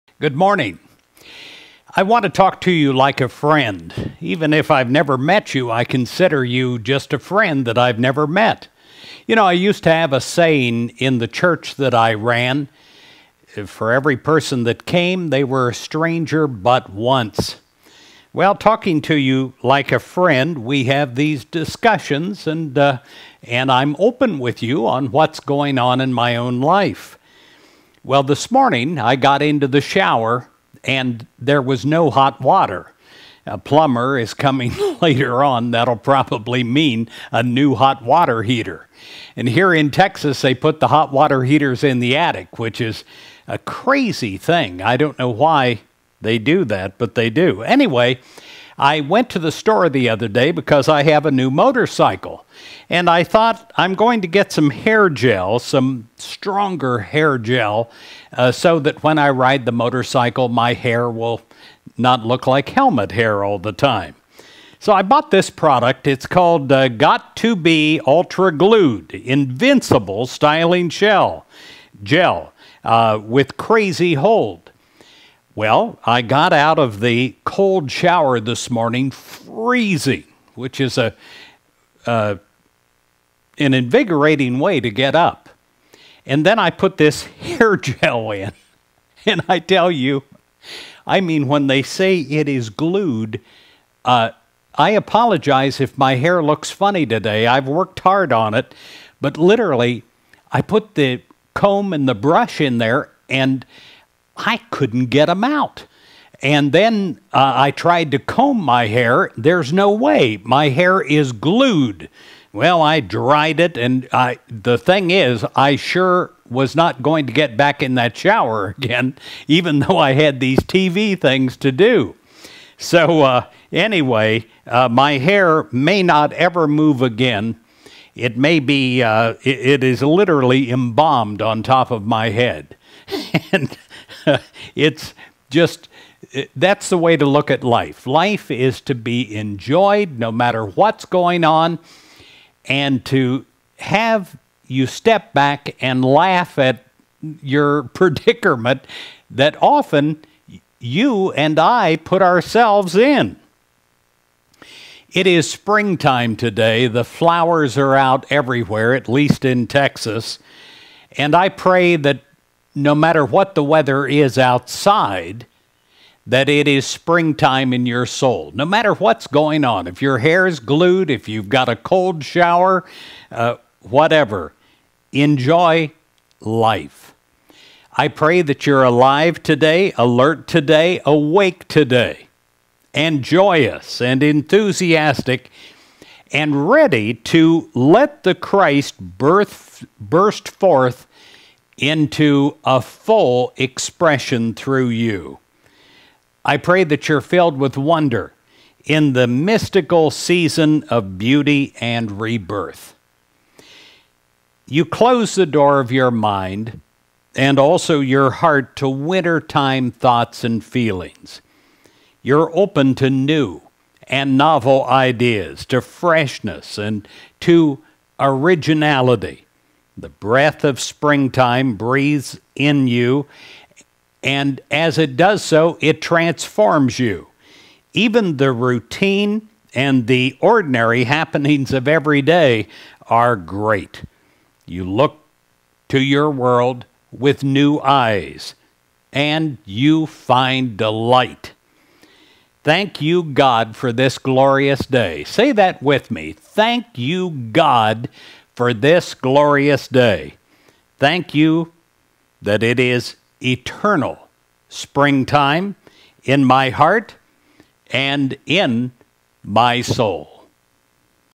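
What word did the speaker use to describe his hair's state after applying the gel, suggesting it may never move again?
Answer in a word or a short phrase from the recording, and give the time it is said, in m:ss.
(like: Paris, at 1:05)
Embalmed, at 2:10.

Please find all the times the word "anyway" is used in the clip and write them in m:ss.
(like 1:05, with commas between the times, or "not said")
0:47, 2:03.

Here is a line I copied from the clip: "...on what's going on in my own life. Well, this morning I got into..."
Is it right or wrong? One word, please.
right.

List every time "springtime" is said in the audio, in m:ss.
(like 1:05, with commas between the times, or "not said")
2:35, 2:46, 3:40, 4:14.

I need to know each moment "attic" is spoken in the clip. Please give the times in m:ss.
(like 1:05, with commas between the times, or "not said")
0:42.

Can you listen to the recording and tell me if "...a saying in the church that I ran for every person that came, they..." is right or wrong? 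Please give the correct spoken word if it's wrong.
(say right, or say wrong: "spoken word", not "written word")
right.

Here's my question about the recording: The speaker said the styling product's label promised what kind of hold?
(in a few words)
Crazy hold.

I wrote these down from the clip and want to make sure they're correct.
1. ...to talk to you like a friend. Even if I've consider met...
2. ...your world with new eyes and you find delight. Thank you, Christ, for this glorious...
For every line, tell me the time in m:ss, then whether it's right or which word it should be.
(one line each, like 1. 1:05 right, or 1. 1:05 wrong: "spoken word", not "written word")
1. 0:02 wrong: "never", not "consider"
2. 3:55 wrong: "God", not "Christ".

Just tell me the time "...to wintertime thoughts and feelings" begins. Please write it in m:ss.
3:28.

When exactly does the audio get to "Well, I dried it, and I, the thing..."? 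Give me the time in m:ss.
1:52.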